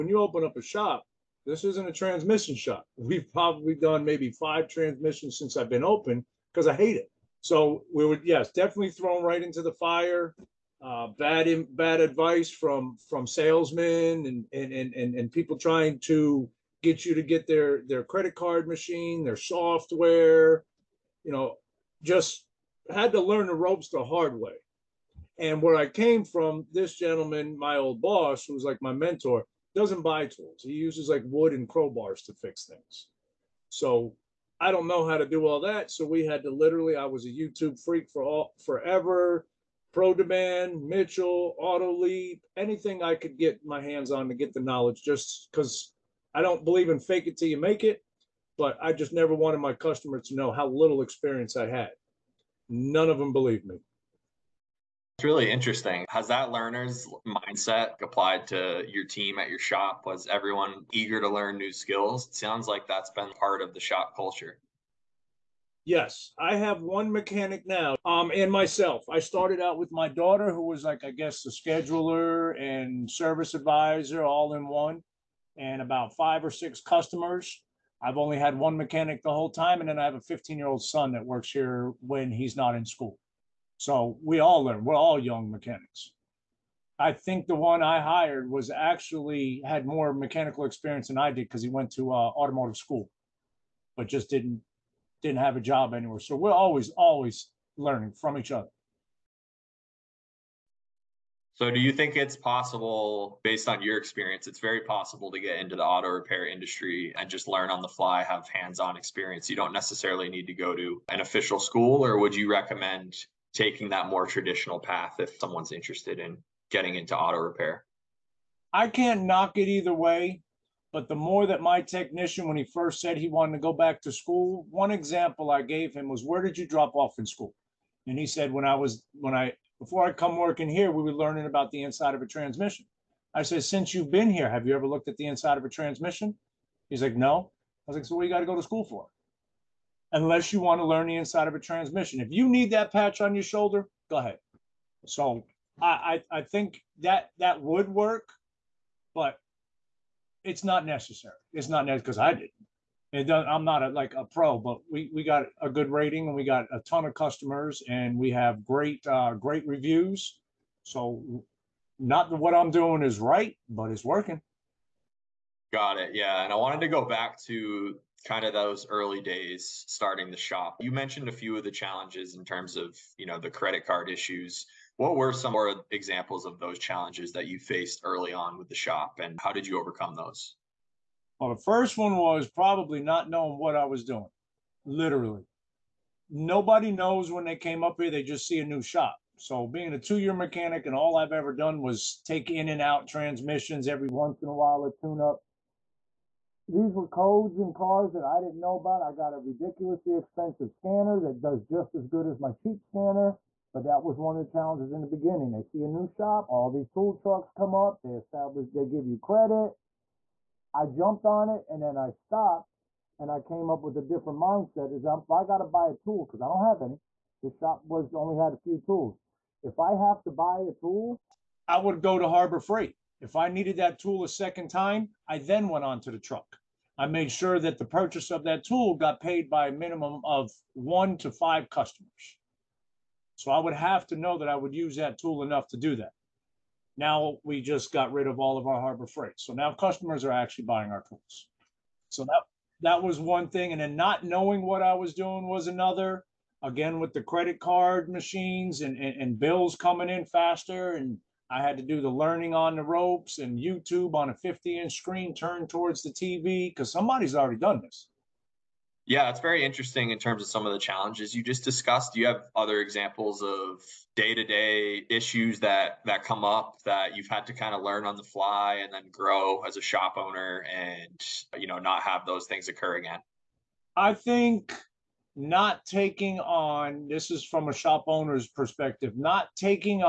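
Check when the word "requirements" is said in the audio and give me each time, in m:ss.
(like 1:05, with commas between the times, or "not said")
not said.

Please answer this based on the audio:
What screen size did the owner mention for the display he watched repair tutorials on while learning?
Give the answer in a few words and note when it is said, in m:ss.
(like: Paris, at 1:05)
50 inch, at 4:14.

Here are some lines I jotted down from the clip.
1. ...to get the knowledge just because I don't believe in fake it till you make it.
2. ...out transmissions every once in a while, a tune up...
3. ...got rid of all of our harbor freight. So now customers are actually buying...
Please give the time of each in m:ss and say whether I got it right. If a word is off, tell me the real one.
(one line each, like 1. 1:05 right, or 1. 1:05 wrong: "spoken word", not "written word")
1. 0:44 right
2. 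3:12 right
3. 3:57 right.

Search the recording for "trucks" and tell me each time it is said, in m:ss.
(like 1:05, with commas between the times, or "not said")
3:27, 3:46.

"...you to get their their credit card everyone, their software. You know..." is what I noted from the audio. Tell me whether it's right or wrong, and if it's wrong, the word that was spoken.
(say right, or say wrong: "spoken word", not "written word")
wrong: "machine", not "everyone".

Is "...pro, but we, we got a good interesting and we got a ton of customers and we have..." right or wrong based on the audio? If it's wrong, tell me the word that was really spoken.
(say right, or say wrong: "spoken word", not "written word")
wrong: "rating", not "interesting".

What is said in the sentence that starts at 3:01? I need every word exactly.
Well, the first one was probably not knowing what I was doing, literally.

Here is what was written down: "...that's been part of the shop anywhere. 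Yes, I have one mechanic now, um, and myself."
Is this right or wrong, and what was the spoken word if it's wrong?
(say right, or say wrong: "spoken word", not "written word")
wrong: "culture", not "anywhere".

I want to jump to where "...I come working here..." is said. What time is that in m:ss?
2:10.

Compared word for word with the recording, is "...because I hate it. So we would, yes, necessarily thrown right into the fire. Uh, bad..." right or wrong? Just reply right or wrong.
wrong.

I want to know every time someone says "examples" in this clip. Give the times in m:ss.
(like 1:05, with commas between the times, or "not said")
2:04, 2:55, 4:22.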